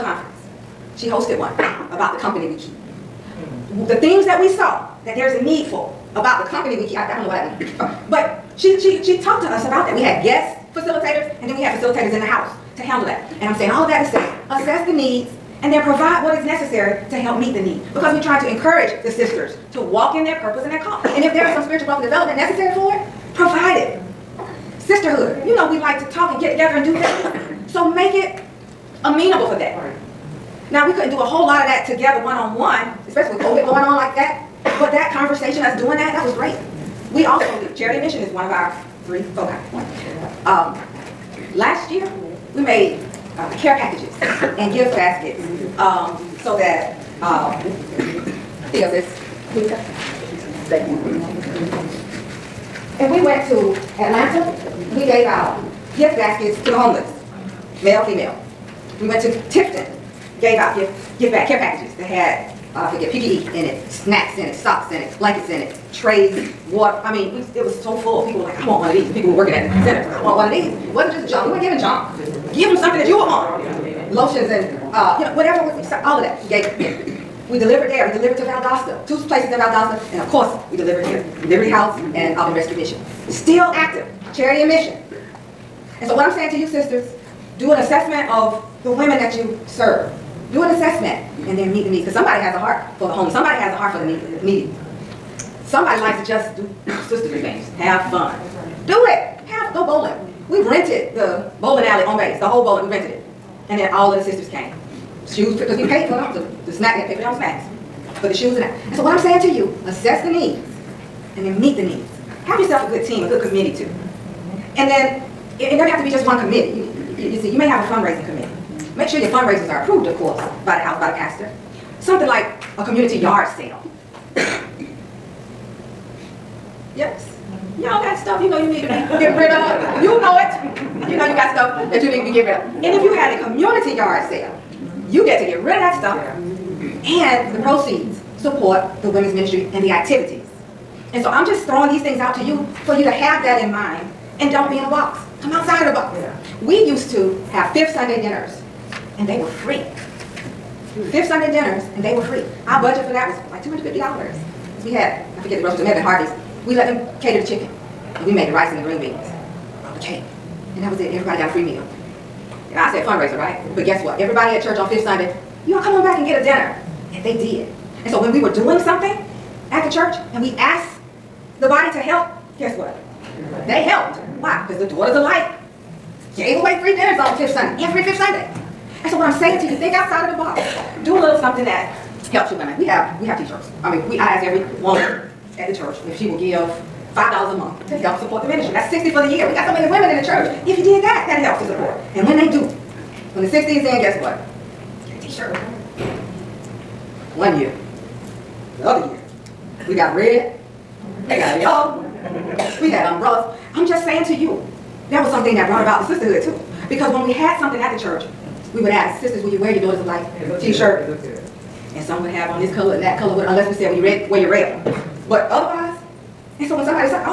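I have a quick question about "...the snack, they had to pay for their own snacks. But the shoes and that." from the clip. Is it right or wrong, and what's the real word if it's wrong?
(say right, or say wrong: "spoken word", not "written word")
right.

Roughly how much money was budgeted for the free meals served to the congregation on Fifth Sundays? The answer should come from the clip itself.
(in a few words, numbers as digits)
$250.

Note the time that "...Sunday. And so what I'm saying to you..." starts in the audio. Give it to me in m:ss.
2:58.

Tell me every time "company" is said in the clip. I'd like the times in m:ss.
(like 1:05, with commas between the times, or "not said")
0:02, 0:06.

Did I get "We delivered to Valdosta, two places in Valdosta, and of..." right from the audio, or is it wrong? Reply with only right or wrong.
right.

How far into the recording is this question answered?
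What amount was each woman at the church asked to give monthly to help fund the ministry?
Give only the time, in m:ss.
3:07.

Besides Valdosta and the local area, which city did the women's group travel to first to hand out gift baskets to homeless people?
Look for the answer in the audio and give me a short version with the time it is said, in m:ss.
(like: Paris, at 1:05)
Atlanta, at 0:54.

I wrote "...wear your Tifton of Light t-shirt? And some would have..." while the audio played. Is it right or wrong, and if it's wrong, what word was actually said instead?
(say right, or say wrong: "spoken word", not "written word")
wrong: "Daughters", not "Tifton".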